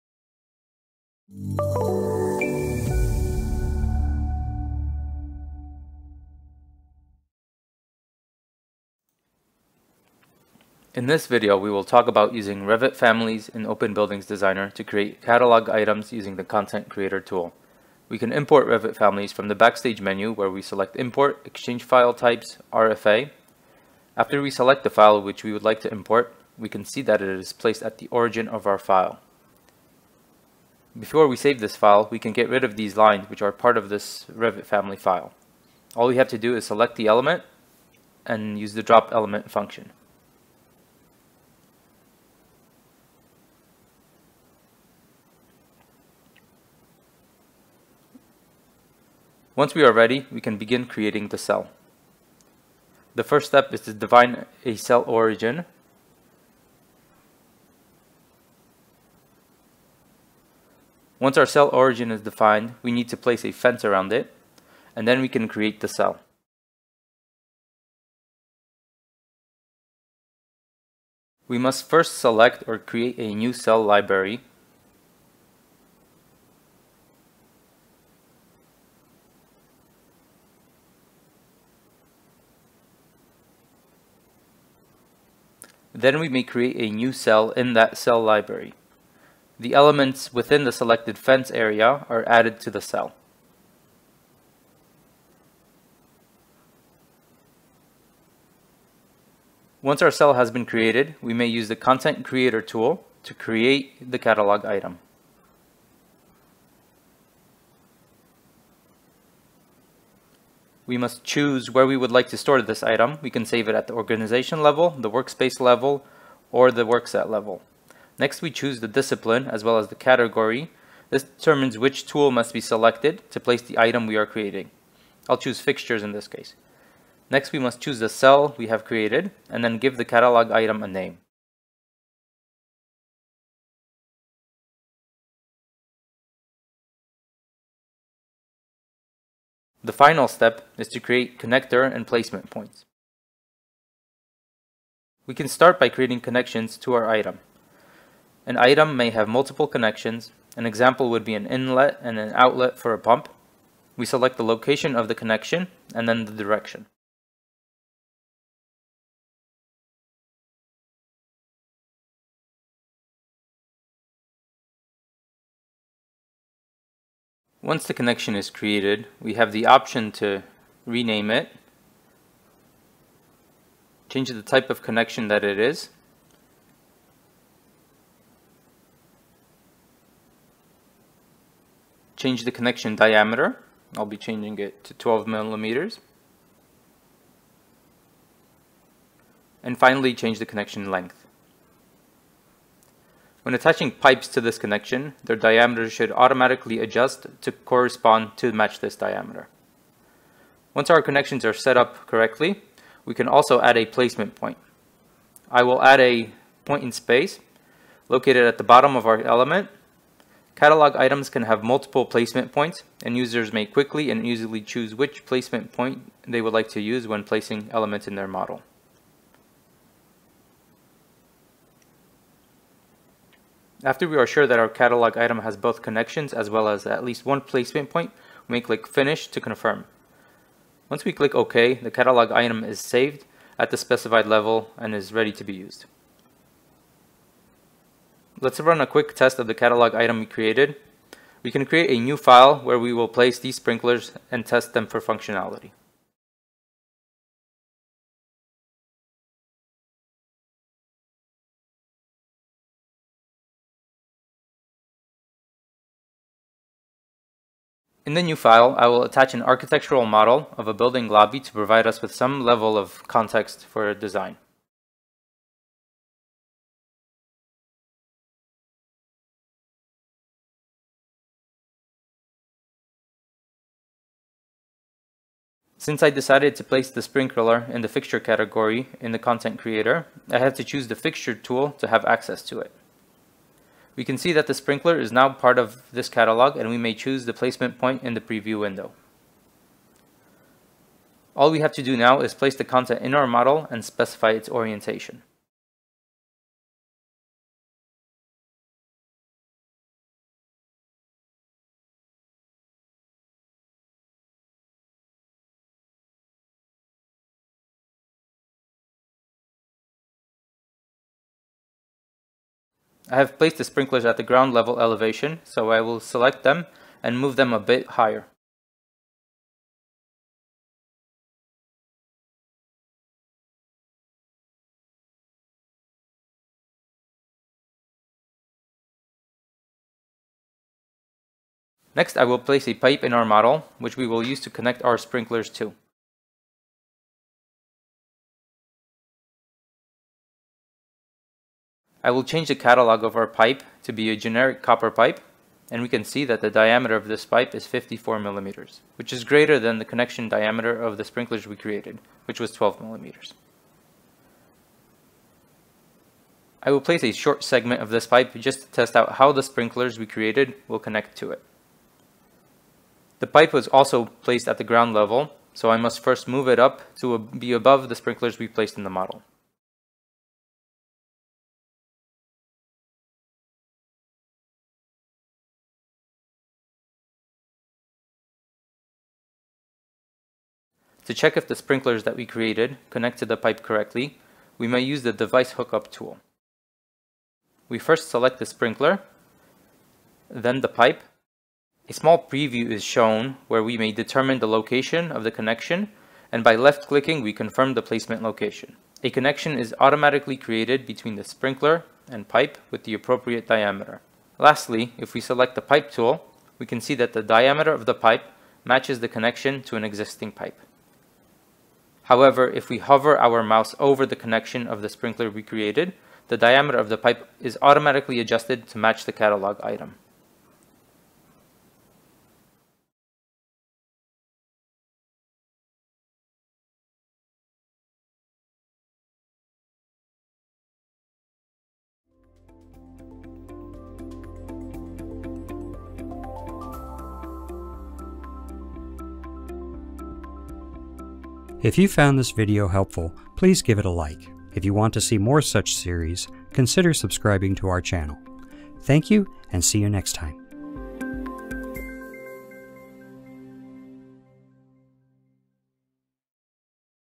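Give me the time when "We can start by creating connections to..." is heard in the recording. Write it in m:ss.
2:25.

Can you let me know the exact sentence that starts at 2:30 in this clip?
An example would be an inlet and an outlet for a pump.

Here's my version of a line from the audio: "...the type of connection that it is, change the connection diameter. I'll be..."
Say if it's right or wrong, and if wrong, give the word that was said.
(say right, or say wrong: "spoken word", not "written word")
right.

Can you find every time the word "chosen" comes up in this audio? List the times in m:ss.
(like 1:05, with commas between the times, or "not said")
not said.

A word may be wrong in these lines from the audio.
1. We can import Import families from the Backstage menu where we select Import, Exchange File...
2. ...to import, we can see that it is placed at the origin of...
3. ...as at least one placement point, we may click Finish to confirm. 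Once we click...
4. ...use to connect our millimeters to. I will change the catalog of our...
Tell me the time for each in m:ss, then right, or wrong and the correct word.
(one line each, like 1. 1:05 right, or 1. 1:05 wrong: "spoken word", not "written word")
1. 0:18 wrong: "Revit", not "Import"
2. 0:25 right
3. 3:46 right
4. 5:34 wrong: "sprinklers", not "millimeters".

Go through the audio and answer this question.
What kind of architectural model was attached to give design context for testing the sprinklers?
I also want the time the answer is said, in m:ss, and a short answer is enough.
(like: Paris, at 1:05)
A building lobby, at 4:20.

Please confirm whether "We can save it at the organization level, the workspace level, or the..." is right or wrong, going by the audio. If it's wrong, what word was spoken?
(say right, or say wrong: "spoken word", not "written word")
right.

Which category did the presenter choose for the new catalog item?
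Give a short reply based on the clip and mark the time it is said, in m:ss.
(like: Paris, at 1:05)
Fixtures, at 2:05.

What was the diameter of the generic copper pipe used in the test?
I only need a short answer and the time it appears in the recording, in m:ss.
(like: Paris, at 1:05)
54 millimeters, at 5:47.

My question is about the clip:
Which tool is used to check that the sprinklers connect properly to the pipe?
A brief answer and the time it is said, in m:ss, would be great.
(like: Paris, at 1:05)
Device hookup tool, at 6:25.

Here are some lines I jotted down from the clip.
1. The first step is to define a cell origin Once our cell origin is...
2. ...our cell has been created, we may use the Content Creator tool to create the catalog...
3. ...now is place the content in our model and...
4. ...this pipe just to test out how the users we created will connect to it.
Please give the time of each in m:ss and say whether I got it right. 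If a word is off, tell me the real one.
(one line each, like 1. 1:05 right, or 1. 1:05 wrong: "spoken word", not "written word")
1. 0:53 right
2. 1:40 right
3. 4:51 right
4. 5:57 wrong: "sprinklers", not "users".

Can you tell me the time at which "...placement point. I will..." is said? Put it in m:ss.
3:23.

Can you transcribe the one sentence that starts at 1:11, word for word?
We must first select or create a new cell library Then we may create a new cell in that cell library.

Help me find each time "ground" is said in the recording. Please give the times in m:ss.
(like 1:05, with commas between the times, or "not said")
5:14, 6:04.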